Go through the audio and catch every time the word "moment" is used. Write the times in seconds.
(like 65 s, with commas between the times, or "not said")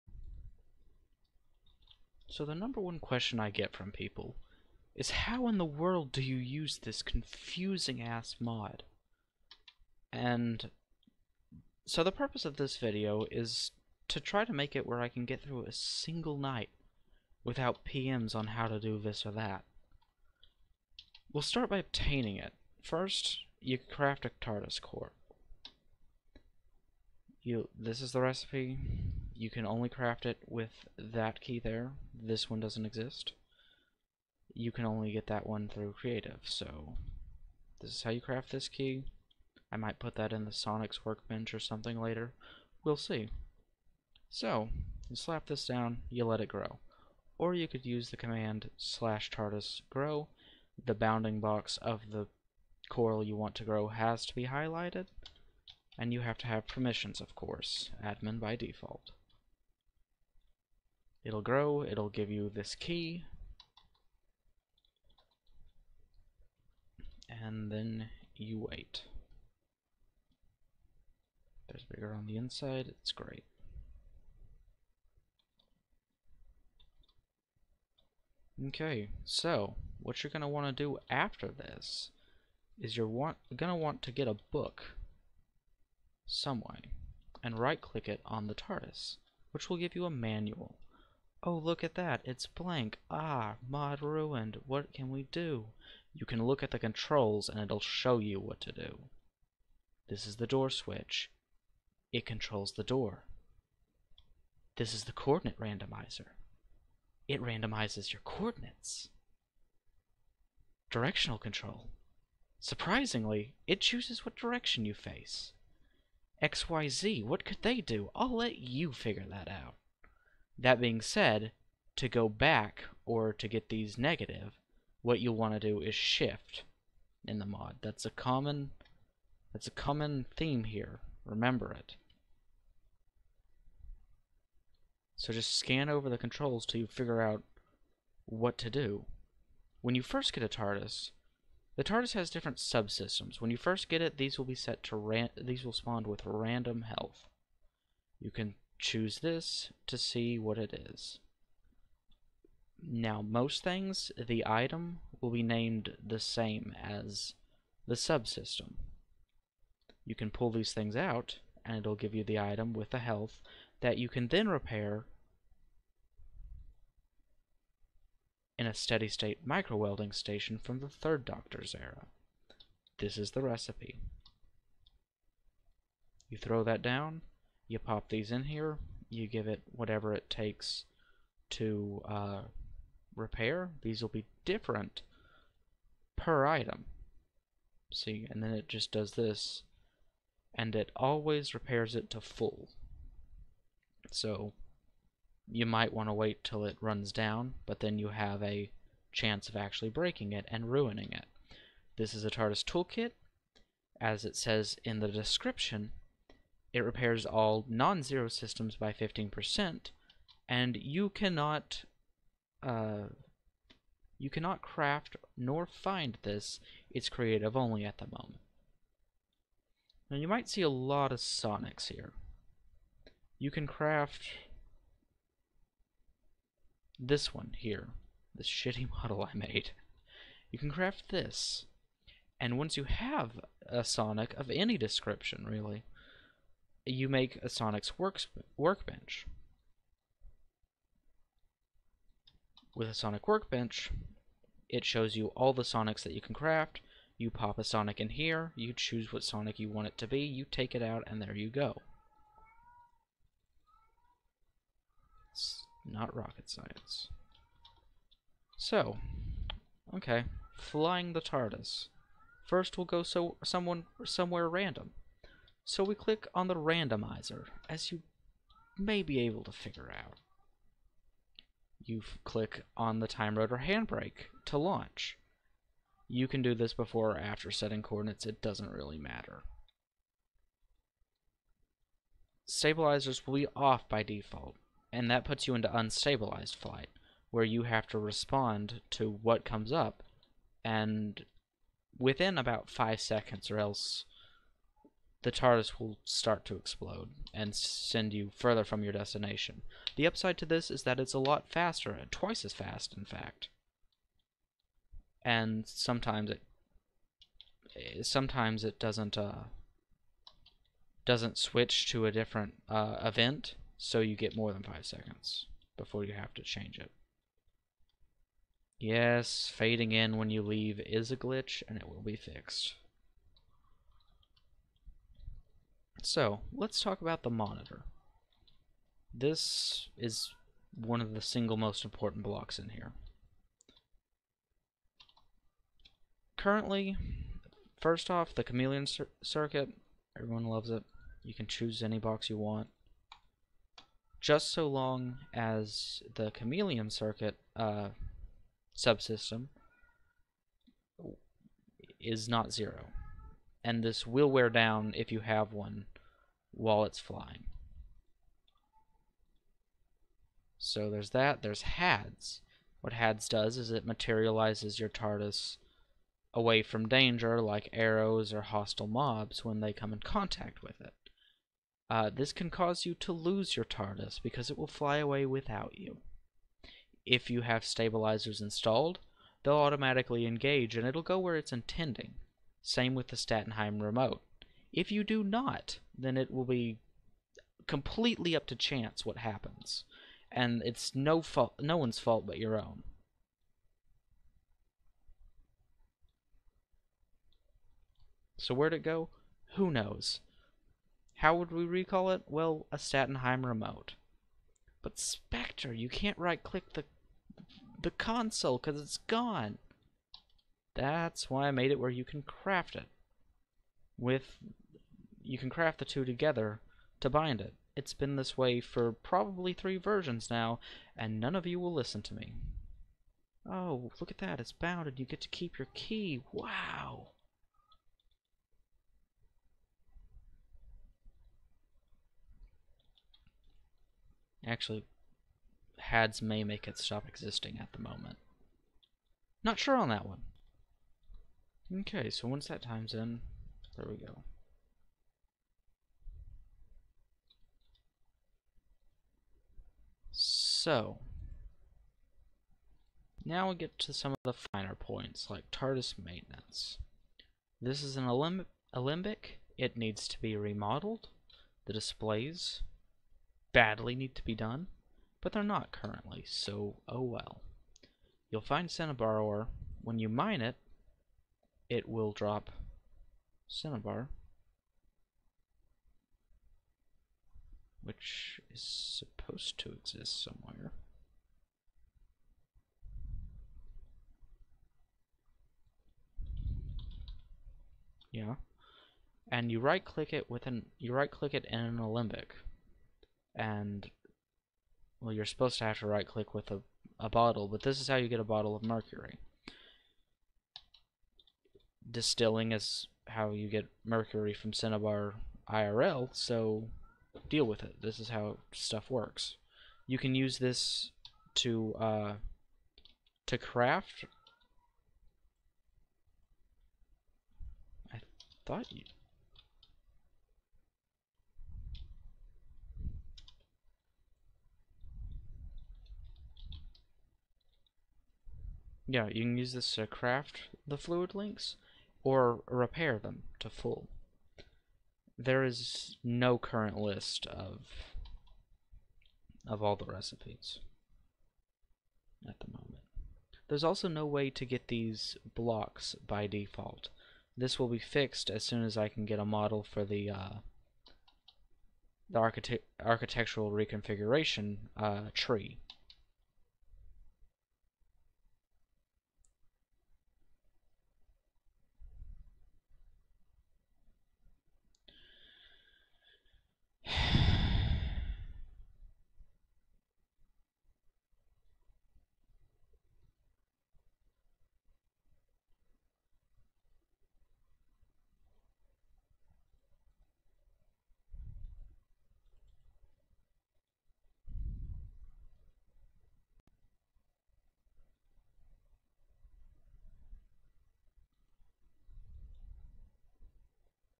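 218 s, 437 s, 542 s.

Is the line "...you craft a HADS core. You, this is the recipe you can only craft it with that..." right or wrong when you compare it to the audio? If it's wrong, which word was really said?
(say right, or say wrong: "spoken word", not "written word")
wrong: "TARDIS", not "HADS".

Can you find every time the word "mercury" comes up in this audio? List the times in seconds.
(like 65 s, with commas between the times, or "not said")
498 s, 503 s.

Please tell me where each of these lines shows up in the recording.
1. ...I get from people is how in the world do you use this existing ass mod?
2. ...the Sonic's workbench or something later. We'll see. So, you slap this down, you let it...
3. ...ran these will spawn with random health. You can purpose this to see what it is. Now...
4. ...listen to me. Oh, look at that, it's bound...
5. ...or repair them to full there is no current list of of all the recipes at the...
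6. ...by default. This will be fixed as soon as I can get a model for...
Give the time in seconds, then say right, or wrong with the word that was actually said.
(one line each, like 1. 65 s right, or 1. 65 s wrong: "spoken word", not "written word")
1. 3 s wrong: "confusing", not "existing"
2. 40 s right
3. 144 s wrong: "choose", not "purpose"
4. 421 s right
5. 532 s right
6. 546 s right.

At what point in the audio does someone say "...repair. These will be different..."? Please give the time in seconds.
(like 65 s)
183 s.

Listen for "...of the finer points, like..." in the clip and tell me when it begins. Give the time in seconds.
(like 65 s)
454 s.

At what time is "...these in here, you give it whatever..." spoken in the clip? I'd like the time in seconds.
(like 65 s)
178 s.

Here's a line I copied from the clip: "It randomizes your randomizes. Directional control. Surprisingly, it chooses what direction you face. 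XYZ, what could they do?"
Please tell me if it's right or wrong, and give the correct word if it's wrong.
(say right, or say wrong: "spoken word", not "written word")
wrong: "coordinates", not "randomizes".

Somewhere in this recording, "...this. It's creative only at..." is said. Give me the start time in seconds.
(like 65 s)
216 s.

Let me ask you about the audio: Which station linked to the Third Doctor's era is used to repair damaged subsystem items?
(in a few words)
Steady state micro-welding station.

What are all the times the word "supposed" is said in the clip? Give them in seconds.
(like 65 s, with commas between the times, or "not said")
478 s, 495 s.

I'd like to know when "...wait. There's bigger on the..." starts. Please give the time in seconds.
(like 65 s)
68 s.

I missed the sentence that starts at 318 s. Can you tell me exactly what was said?
Yes, fading in when you leave is a glitch, and it will be fixed.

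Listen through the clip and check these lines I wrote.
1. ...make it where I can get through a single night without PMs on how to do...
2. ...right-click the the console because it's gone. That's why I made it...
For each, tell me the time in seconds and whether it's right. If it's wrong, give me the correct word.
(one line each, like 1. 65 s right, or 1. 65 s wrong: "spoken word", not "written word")
1. 14 s right
2. 406 s right.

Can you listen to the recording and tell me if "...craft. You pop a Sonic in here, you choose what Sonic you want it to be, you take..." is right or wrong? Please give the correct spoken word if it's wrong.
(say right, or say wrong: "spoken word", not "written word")
right.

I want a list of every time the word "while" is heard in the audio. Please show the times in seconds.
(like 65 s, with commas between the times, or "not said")
356 s.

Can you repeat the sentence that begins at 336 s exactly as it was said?
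Currently, first off, the chameleon cir circuit, everyone loves it.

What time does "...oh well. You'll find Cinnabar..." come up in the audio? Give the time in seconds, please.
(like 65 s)
466 s.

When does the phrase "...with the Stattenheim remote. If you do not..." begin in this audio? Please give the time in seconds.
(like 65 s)
382 s.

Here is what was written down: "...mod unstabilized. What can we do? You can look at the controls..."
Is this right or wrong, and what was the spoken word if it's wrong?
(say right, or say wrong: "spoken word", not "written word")
wrong: "ruined", not "unstabilized".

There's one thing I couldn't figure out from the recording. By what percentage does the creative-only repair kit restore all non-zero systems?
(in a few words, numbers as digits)
15%.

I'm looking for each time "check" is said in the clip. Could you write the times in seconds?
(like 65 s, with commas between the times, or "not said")
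not said.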